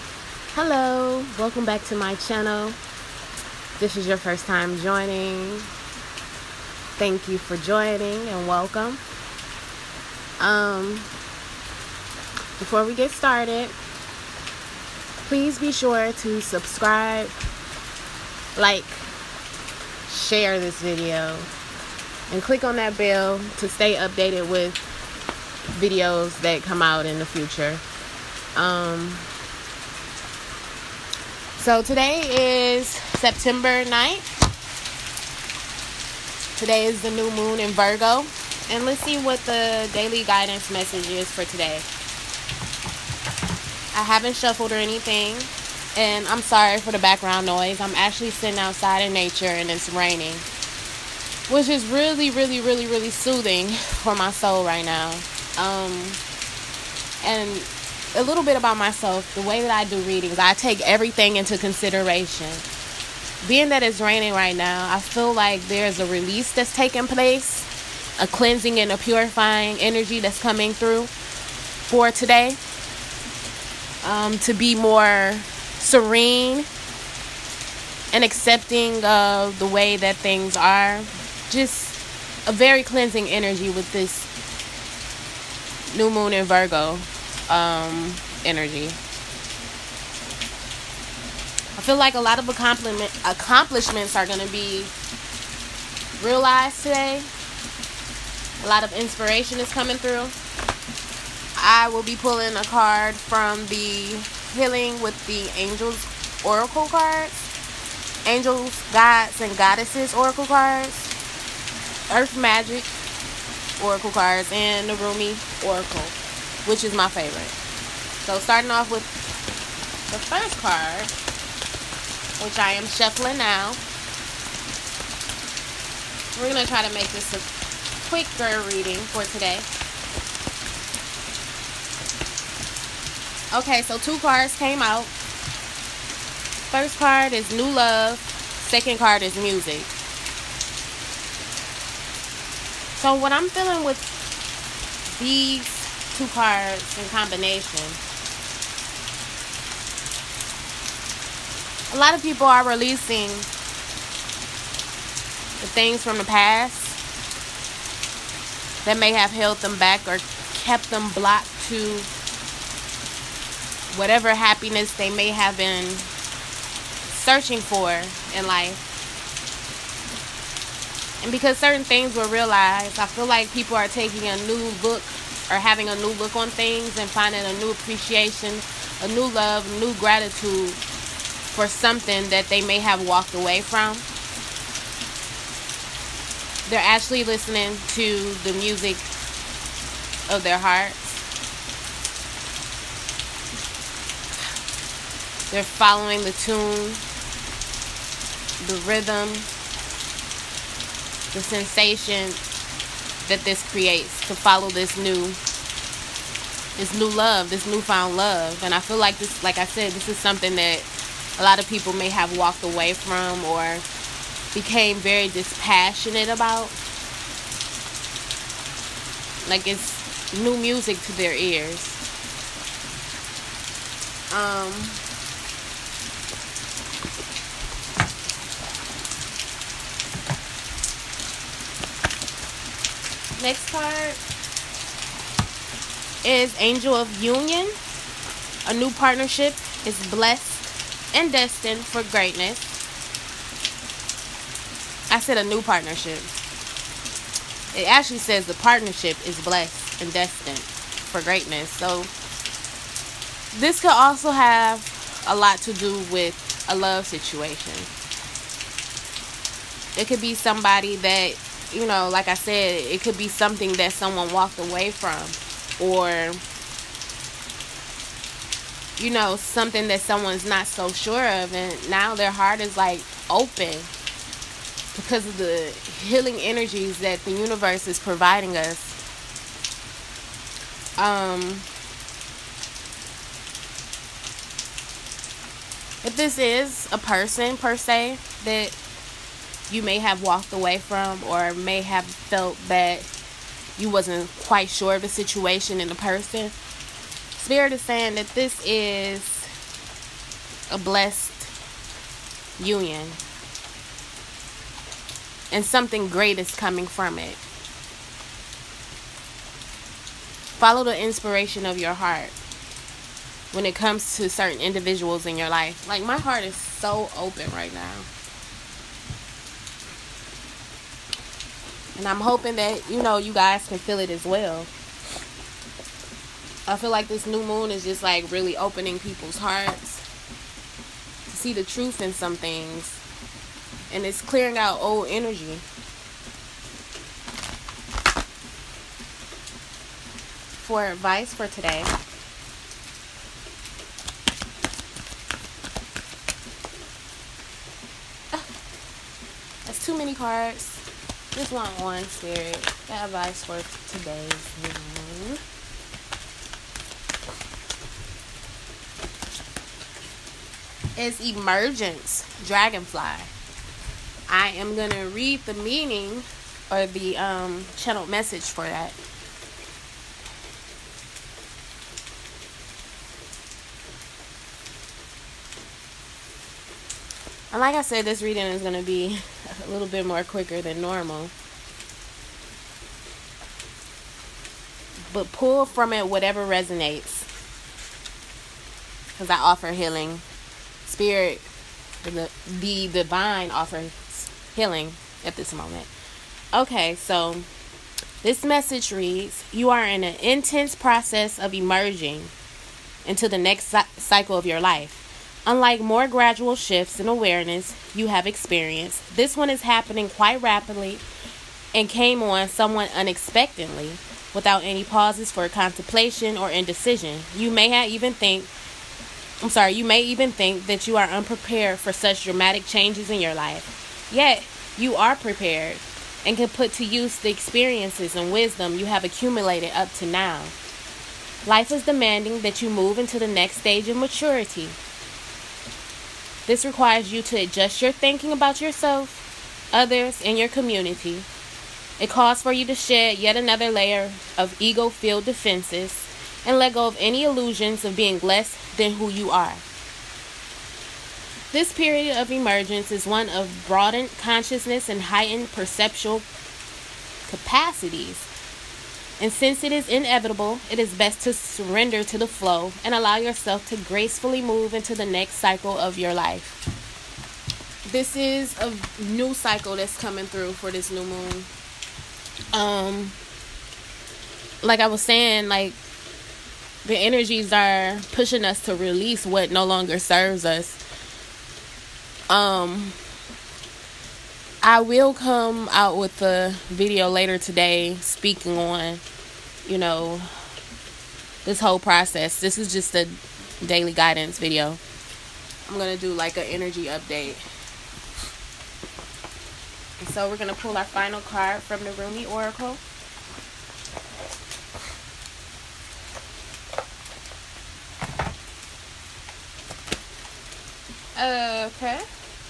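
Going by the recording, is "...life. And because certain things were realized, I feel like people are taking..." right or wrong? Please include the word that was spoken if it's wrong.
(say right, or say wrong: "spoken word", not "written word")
right.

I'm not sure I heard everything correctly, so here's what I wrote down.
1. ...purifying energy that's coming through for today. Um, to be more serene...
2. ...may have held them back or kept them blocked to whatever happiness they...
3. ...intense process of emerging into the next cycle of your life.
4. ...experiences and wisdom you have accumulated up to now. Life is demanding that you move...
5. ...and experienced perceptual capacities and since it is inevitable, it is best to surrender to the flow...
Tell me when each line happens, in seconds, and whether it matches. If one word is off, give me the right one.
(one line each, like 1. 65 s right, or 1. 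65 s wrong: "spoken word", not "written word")
1. 68 s right
2. 158 s right
3. 400 s right
4. 427 s right
5. 454 s wrong: "heightened", not "experienced".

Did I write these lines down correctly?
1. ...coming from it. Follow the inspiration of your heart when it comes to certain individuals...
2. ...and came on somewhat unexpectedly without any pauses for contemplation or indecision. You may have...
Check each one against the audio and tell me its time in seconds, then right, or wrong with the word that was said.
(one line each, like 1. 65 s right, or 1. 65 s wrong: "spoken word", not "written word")
1. 306 s right
2. 411 s right.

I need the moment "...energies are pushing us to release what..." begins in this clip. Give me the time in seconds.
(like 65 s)
476 s.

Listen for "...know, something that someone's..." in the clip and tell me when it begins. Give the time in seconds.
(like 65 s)
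269 s.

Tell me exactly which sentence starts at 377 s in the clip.
And like I said, this reading is going to be a little bit more quicker than normal.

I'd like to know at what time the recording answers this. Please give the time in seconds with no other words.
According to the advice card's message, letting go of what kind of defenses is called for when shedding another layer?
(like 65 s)
444 s.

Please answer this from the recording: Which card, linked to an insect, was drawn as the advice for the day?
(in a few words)
Emergence Dragonfly.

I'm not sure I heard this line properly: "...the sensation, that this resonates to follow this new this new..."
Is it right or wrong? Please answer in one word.
wrong.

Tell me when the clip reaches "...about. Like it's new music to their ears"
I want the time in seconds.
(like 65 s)
216 s.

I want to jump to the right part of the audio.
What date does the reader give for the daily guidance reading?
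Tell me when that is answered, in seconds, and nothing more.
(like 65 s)
32 s.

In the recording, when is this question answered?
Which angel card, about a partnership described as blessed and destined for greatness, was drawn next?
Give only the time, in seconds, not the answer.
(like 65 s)
236 s.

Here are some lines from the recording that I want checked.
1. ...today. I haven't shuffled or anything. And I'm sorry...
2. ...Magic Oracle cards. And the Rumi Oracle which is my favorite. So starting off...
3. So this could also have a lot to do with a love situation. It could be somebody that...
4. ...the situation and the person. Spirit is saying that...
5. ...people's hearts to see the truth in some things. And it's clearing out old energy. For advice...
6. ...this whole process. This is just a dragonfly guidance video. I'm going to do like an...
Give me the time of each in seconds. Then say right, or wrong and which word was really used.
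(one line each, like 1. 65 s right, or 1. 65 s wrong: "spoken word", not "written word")
1. 41 s right
2. 112 s right
3. 251 s right
4. 295 s right
5. 329 s right
6. 491 s wrong: "daily", not "dragonfly".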